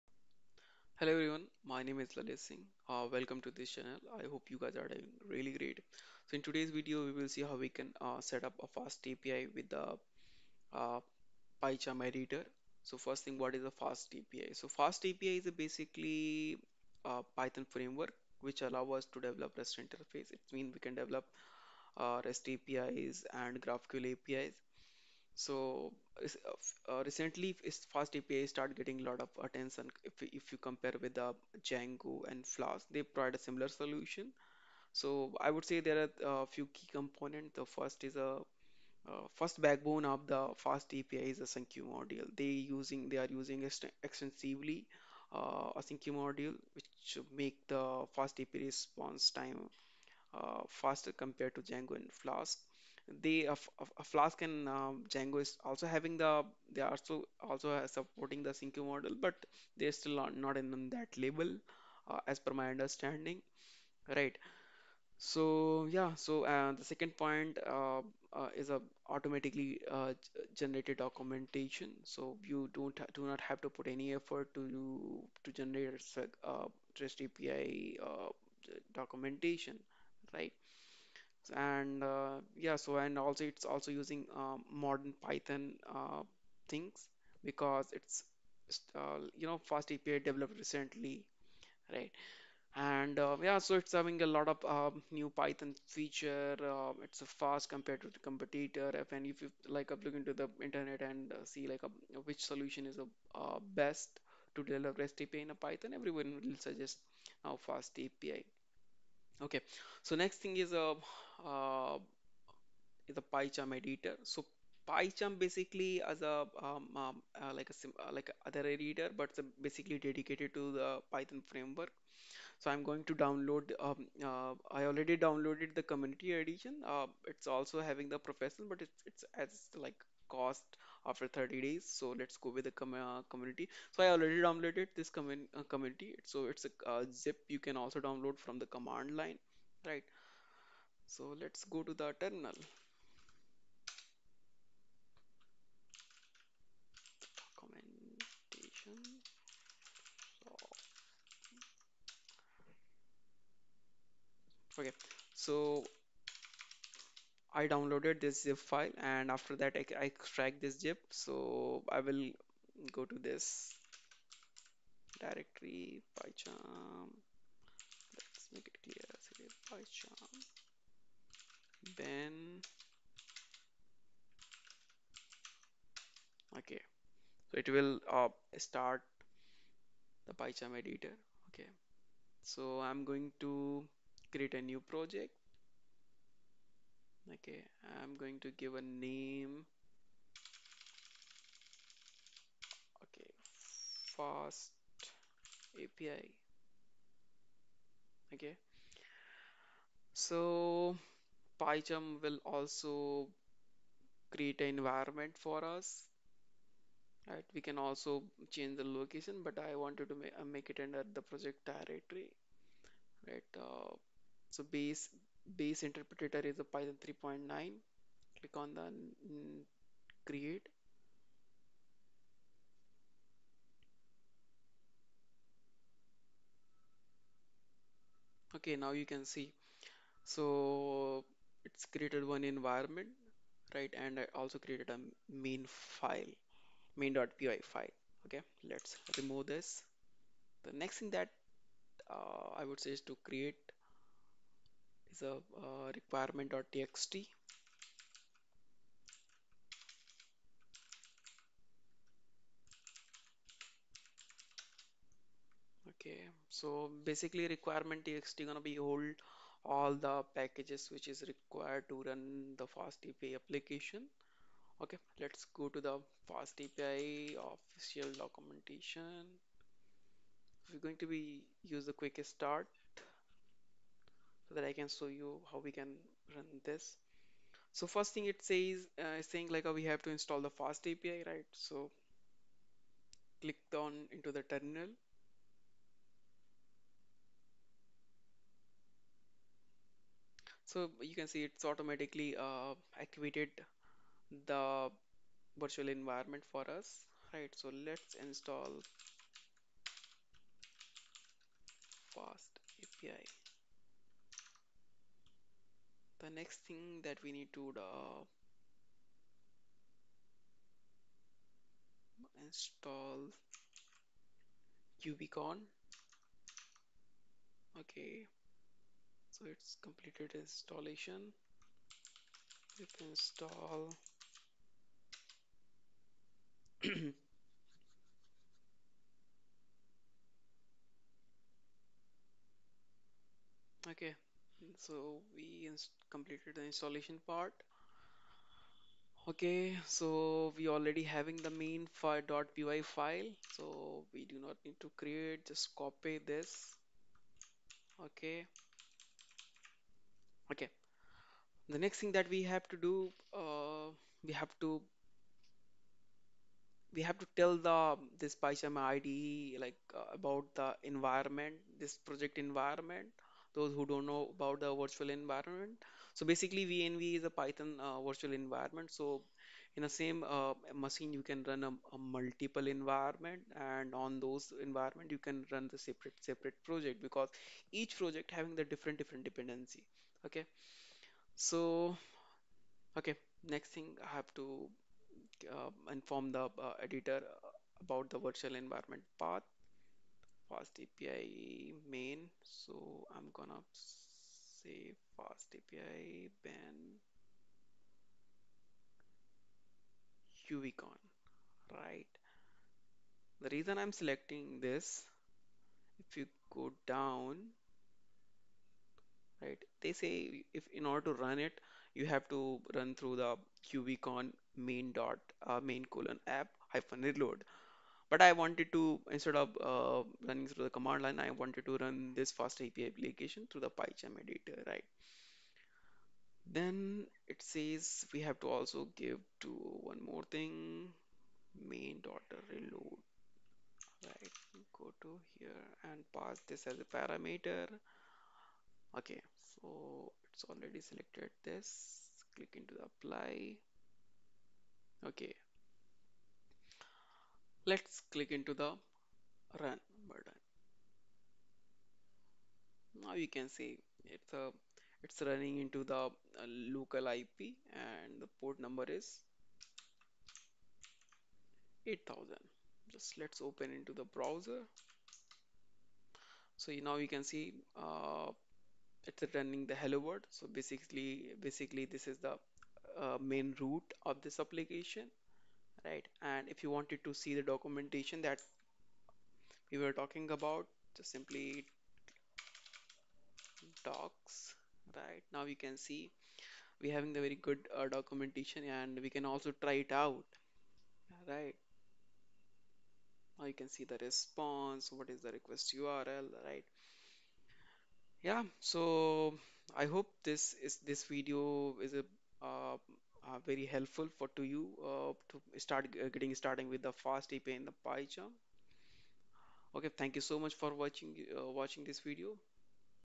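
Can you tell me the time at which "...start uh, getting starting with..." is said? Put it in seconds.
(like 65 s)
505 s.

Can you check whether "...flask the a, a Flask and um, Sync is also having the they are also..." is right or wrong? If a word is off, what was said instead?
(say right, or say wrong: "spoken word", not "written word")
wrong: "Django", not "Sync".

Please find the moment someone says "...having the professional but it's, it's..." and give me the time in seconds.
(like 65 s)
127 s.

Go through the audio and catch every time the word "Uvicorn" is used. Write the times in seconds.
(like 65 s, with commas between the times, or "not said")
400 s, 413 s.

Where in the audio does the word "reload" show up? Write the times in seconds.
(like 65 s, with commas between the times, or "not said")
417 s, 432 s.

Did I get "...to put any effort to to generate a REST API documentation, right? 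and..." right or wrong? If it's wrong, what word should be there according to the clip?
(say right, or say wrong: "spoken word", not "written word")
right.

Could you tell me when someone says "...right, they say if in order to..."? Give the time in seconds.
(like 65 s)
409 s.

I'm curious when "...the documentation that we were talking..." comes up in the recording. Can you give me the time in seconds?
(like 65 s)
477 s.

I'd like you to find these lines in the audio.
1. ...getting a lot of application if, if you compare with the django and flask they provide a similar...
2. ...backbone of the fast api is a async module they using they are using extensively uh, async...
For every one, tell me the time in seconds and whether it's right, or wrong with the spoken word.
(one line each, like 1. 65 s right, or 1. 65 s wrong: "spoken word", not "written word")
1. 28 s wrong: "attention", not "application"
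2. 39 s right.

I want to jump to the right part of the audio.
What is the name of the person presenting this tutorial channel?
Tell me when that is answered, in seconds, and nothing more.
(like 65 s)
2 s.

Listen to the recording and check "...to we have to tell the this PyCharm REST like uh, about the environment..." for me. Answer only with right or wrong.
wrong.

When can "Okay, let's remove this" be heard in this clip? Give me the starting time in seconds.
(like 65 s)
238 s.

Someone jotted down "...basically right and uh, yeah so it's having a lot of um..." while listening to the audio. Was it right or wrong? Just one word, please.
wrong.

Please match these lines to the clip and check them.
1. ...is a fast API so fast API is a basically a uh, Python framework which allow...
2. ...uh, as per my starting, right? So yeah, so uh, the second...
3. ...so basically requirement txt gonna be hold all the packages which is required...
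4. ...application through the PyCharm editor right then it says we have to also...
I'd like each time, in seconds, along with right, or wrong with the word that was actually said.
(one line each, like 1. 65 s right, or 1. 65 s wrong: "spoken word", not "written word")
1. 13 s right
2. 62 s wrong: "understanding", not "starting"
3. 256 s right
4. 422 s right.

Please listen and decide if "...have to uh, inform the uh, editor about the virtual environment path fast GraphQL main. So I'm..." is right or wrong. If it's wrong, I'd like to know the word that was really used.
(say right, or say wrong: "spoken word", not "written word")
wrong: "API", not "GraphQL".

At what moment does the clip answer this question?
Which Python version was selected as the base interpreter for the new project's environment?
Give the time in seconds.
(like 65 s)
216 s.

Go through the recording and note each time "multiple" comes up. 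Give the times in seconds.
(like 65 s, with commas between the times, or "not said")
371 s.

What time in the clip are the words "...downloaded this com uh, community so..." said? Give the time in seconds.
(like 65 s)
134 s.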